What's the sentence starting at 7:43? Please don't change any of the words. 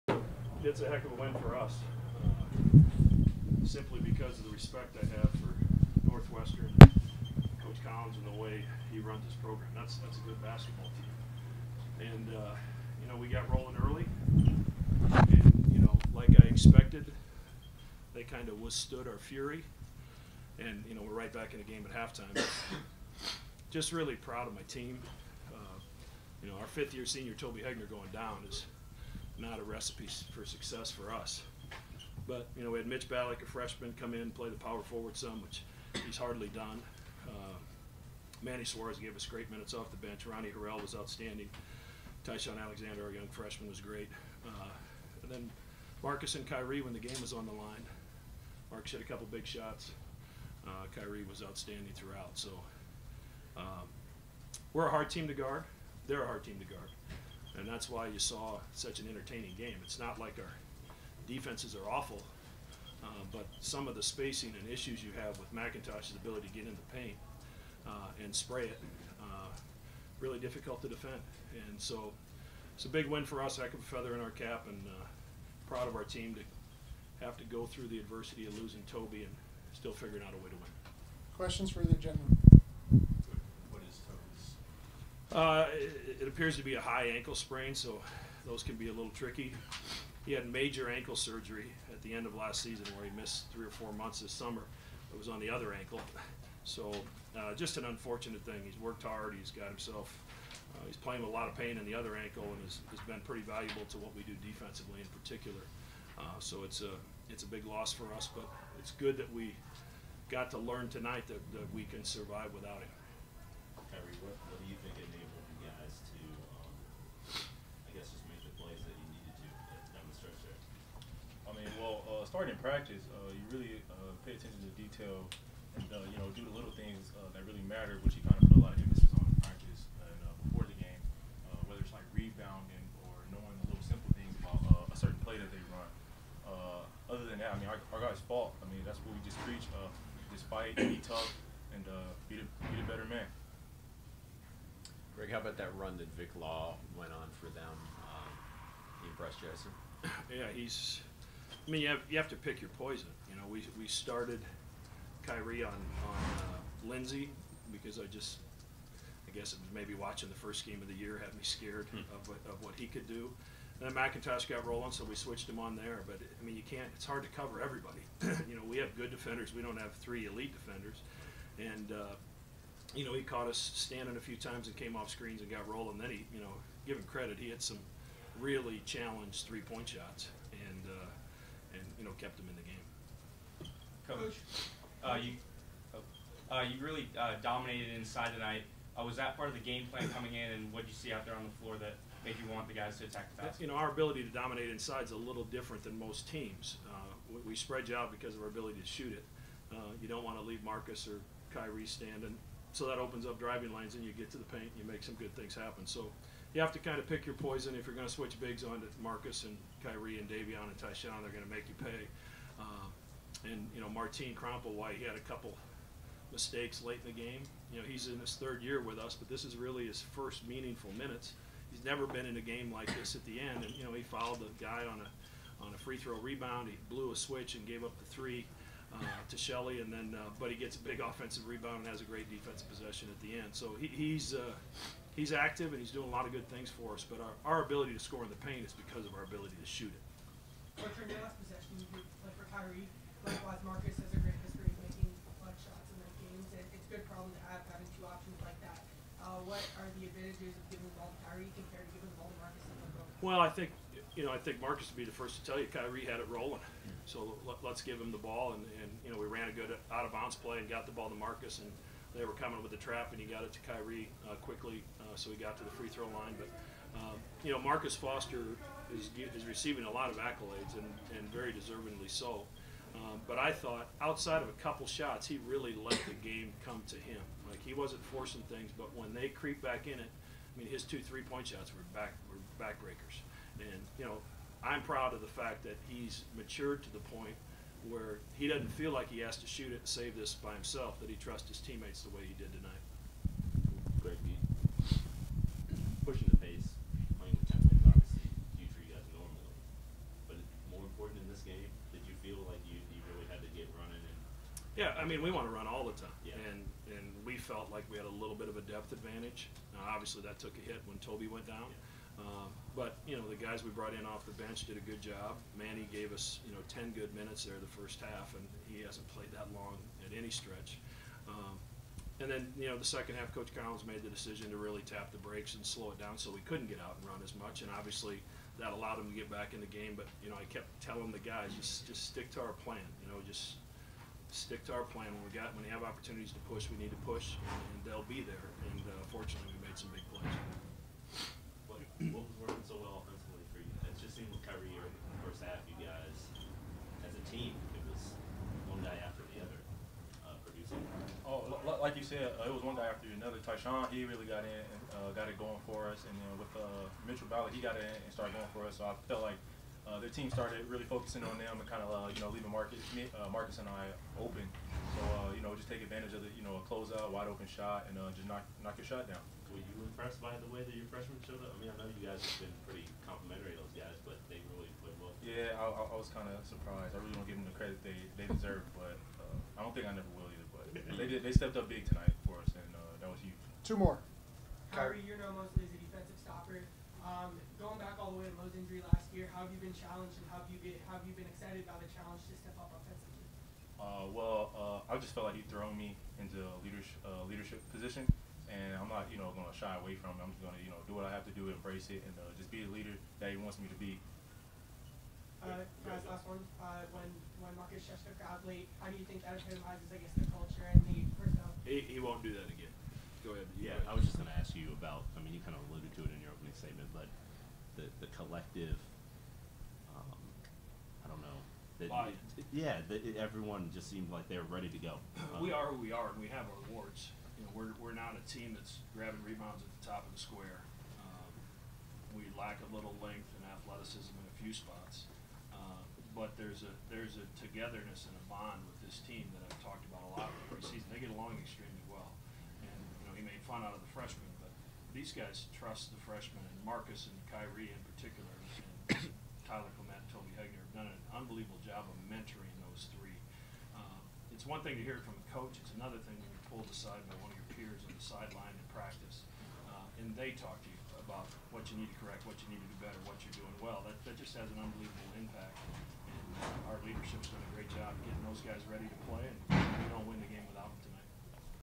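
That that just has an unbelievable impact.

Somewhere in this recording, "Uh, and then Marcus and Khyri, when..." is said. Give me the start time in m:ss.
0:44.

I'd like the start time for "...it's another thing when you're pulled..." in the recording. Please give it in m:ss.
7:35.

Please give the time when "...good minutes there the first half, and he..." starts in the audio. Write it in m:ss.
5:16.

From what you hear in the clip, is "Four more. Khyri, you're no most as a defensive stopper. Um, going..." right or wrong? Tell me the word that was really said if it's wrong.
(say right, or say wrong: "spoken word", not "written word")
wrong: "Two", not "Four".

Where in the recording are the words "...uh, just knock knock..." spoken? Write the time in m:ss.
6:07.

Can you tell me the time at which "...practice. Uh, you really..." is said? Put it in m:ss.
2:02.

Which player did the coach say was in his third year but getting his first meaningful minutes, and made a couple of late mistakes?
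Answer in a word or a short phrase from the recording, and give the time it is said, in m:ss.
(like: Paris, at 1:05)
Martin Krampelj, at 3:33.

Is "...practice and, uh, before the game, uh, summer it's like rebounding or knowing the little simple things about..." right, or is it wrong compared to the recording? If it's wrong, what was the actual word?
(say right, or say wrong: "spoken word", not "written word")
wrong: "whether", not "summer".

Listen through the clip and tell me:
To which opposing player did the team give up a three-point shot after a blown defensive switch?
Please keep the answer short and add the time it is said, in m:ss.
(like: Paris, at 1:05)
Skelly, at 3:49.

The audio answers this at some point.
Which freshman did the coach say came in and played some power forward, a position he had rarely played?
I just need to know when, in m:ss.
0:32.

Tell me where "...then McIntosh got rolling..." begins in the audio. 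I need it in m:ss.
2:43.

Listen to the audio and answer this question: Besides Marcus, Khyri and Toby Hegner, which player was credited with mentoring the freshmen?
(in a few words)
Tyler Clement.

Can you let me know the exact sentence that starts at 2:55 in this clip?
Then he, you know, give him credit.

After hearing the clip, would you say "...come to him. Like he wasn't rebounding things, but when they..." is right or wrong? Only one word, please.
wrong.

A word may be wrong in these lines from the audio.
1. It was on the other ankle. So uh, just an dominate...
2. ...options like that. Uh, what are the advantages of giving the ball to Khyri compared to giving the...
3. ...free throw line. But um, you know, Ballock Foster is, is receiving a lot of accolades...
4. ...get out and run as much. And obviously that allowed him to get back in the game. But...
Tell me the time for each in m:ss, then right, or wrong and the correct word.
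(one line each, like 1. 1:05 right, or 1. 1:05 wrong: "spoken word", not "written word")
1. 1:35 wrong: "unfortunate", not "dominate"
2. 4:08 right
3. 4:25 wrong: "Marcus", not "Ballock"
4. 5:26 right.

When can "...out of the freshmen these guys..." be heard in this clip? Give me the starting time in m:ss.
7:23.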